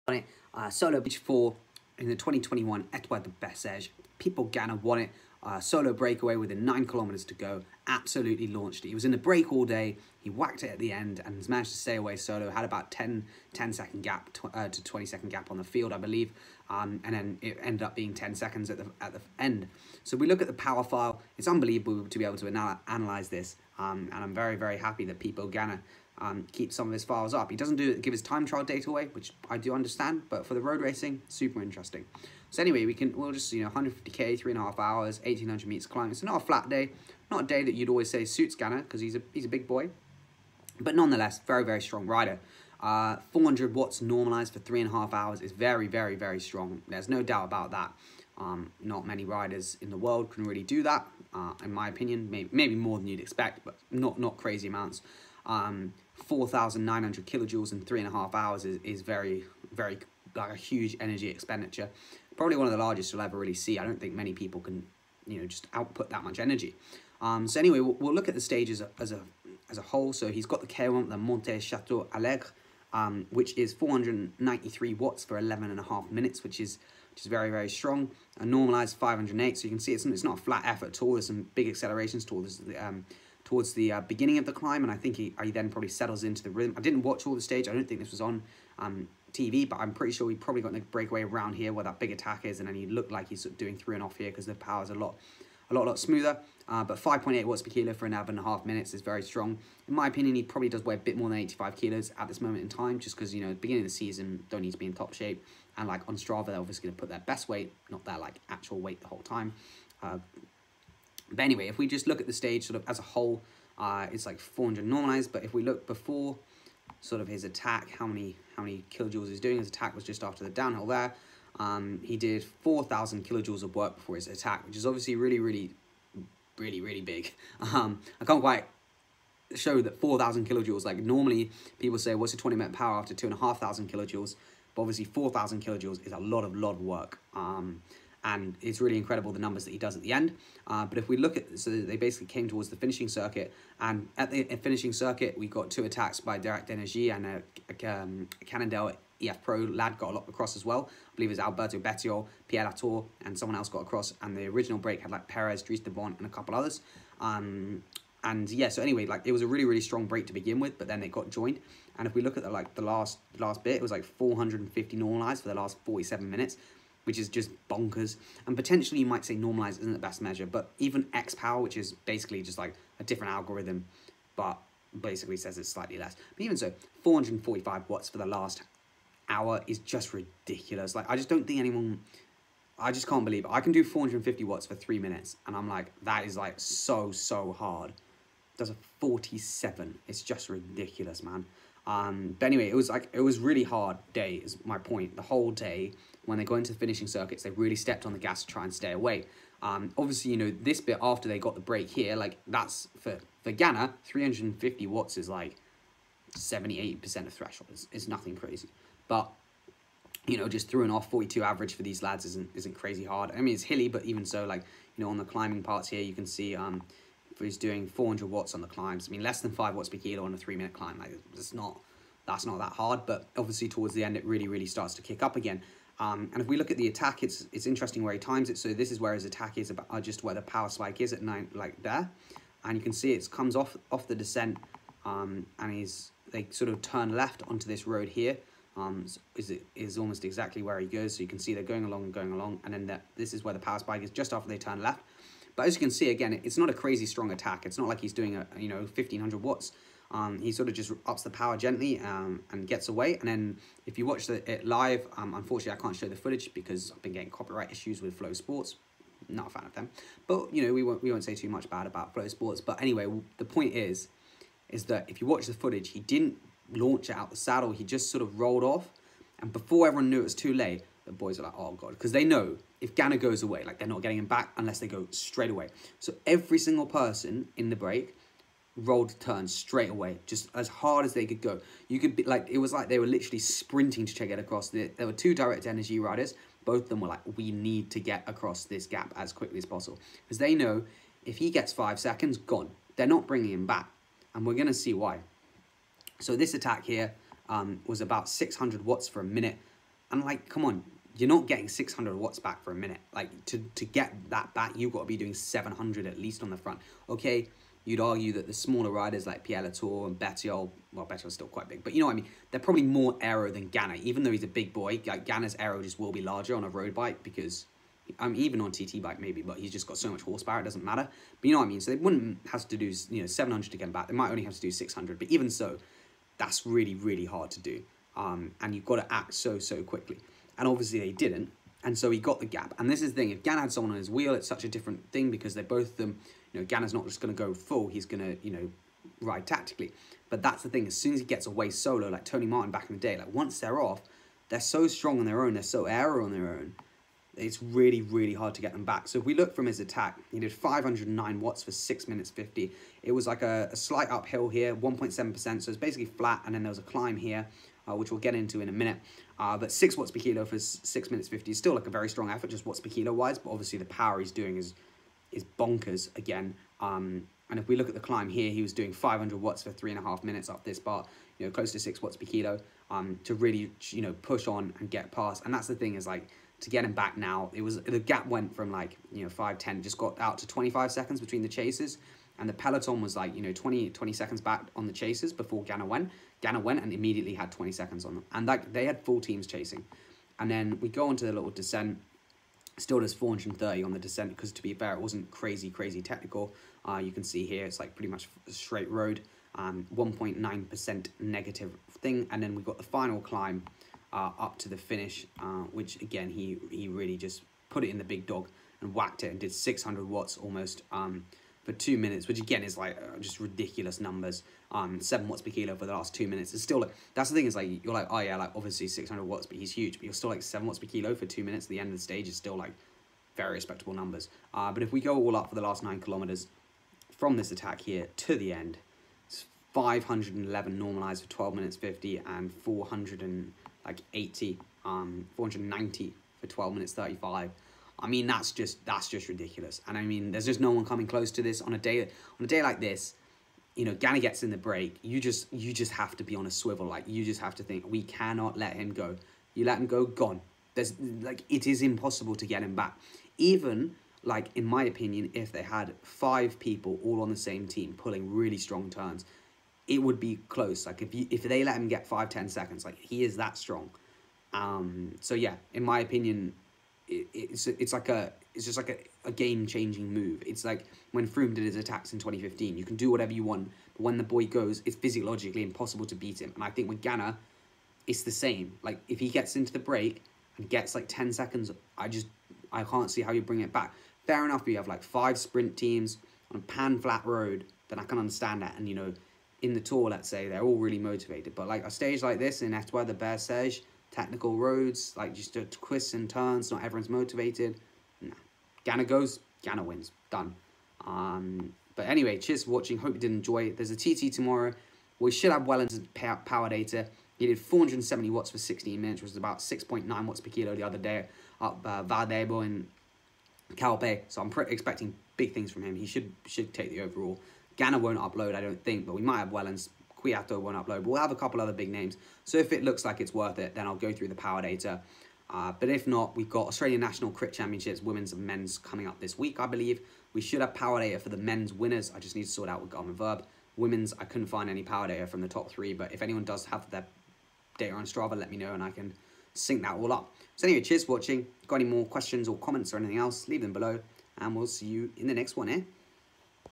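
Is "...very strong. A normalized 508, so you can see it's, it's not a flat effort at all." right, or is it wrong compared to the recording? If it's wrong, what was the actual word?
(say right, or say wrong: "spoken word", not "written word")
right.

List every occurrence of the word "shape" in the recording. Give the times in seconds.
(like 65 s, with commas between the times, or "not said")
105 s.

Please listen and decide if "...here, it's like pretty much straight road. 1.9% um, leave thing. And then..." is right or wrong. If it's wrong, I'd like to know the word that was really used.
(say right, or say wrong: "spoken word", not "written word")
wrong: "negative", not "leave".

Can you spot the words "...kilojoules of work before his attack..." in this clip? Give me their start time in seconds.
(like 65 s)
123 s.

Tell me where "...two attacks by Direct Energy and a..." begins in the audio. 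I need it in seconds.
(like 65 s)
145 s.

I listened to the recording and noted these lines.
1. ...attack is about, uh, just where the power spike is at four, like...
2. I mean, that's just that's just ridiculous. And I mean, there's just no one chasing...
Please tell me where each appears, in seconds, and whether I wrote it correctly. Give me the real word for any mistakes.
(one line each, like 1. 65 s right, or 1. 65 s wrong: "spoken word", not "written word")
1. 229 s wrong: "nine", not "four"
2. 438 s wrong: "coming", not "chasing".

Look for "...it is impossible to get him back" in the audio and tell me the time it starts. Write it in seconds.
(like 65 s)
451 s.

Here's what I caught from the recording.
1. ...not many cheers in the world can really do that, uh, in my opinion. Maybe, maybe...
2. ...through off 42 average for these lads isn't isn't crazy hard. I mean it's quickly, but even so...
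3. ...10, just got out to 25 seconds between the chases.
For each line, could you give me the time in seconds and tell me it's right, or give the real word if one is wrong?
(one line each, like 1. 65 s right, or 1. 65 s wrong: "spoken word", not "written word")
1. 48 s wrong: "riders", not "cheers"
2. 210 s wrong: "hilly", not "quickly"
3. 379 s right.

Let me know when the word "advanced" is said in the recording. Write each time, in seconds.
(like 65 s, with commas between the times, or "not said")
not said.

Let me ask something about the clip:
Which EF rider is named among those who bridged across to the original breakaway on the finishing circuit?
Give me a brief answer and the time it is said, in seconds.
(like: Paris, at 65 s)
Alberto Bettiol, at 151 s.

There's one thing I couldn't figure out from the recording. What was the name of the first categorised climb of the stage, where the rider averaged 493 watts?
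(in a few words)
Monte Chateau Alegre.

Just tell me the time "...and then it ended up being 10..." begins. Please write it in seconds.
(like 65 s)
17 s.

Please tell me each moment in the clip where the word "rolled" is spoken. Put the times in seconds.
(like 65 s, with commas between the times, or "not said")
268 s, 278 s.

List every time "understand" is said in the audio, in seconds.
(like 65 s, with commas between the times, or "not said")
29 s, 488 s.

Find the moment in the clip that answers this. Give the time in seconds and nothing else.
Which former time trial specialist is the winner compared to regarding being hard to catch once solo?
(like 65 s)
342 s.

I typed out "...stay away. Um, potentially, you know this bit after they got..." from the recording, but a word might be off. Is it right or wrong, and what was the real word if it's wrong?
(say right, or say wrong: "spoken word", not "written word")
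wrong: "obviously", not "potentially".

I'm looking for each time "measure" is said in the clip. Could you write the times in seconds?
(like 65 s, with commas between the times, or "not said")
170 s.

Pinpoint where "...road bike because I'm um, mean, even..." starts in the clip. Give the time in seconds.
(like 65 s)
316 s.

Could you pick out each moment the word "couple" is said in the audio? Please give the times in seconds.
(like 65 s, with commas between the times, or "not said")
156 s, 521 s.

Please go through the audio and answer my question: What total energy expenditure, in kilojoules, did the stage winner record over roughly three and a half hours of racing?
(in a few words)
4,900.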